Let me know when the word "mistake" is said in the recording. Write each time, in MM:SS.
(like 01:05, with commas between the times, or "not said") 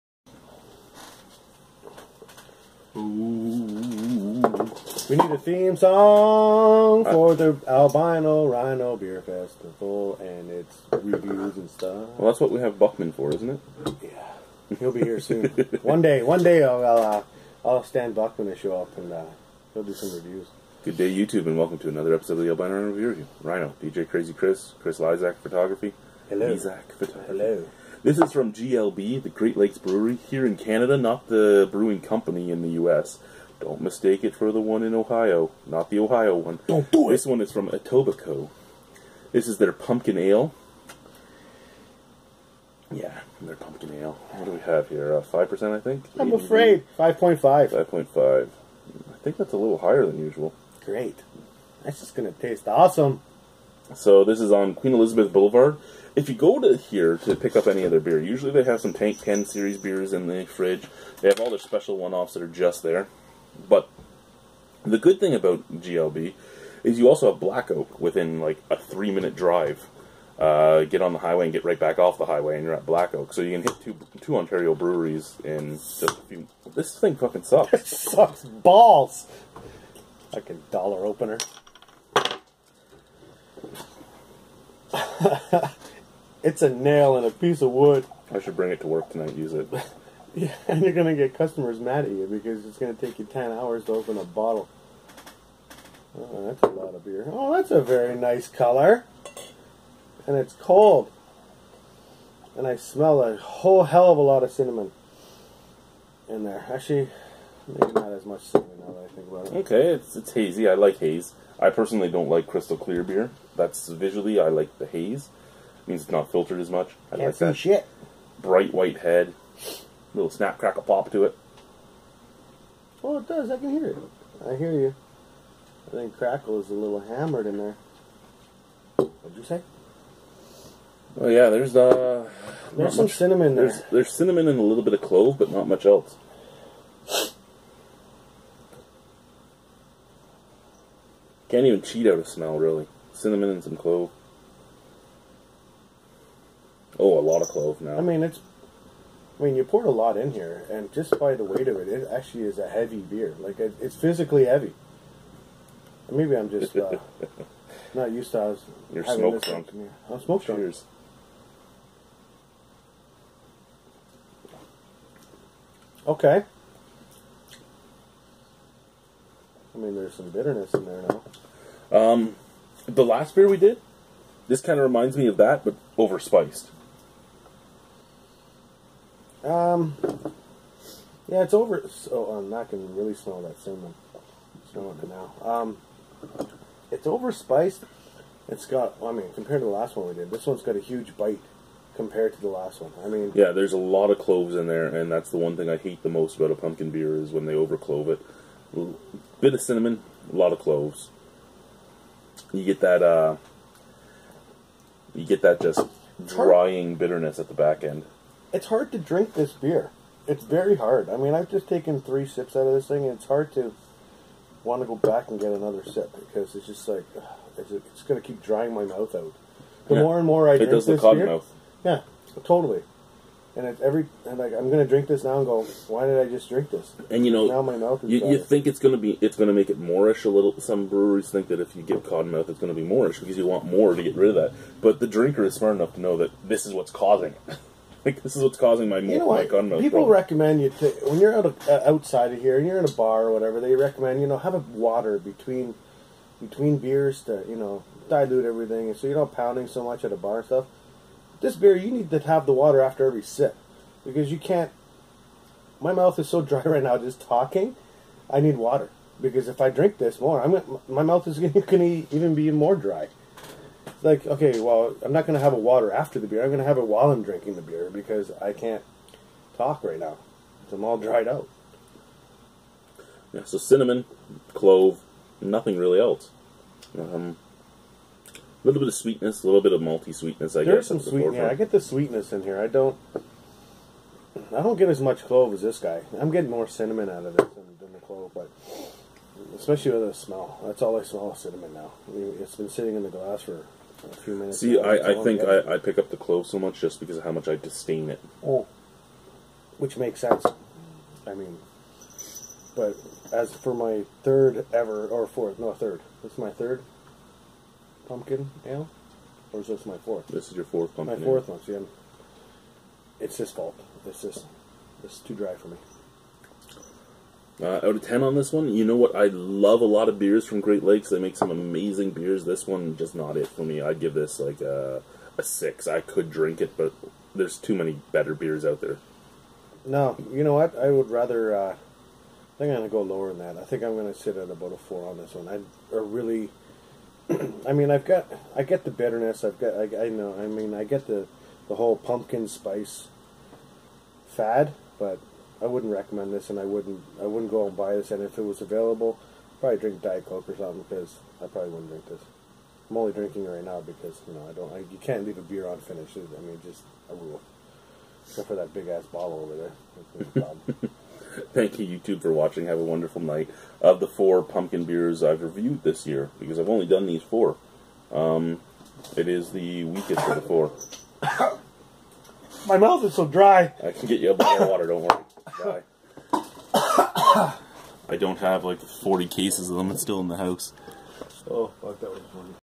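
00:33.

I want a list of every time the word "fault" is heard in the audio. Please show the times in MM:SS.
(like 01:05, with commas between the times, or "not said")
05:13.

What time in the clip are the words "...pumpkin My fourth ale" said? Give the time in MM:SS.
05:10.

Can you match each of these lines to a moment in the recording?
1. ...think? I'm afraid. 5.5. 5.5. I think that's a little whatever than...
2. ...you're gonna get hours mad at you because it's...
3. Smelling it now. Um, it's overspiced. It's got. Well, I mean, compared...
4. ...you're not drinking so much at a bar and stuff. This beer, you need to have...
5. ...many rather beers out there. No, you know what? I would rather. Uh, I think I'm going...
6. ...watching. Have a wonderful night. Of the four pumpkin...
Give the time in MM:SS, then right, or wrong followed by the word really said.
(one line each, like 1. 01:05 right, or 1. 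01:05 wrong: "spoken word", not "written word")
1. 00:45 wrong: "higher", not "whatever"
2. 01:30 wrong: "customers", not "hours"
3. 03:04 right
4. 04:09 wrong: "pounding", not "drinking"
5. 05:27 wrong: "better", not "rather"
6. 06:02 right.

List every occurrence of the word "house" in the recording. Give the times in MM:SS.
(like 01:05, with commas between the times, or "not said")
06:20.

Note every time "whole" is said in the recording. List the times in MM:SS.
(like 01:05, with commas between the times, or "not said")
01:43, 05:41.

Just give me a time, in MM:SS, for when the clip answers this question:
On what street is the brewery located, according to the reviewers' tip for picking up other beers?
00:54.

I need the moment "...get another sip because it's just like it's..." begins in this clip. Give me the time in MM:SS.
03:35.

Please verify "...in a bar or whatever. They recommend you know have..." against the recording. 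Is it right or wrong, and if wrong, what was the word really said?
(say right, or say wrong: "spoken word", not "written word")
right.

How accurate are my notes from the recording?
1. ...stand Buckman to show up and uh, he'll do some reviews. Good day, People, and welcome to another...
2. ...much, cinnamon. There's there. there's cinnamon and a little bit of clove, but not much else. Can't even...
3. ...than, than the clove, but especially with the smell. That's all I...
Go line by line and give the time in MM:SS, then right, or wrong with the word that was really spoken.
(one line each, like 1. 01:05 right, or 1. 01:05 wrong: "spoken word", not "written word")
1. 00:17 wrong: "YouTube", not "People"
2. 02:13 right
3. 04:47 right.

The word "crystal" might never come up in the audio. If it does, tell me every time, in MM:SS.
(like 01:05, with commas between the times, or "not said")
01:52.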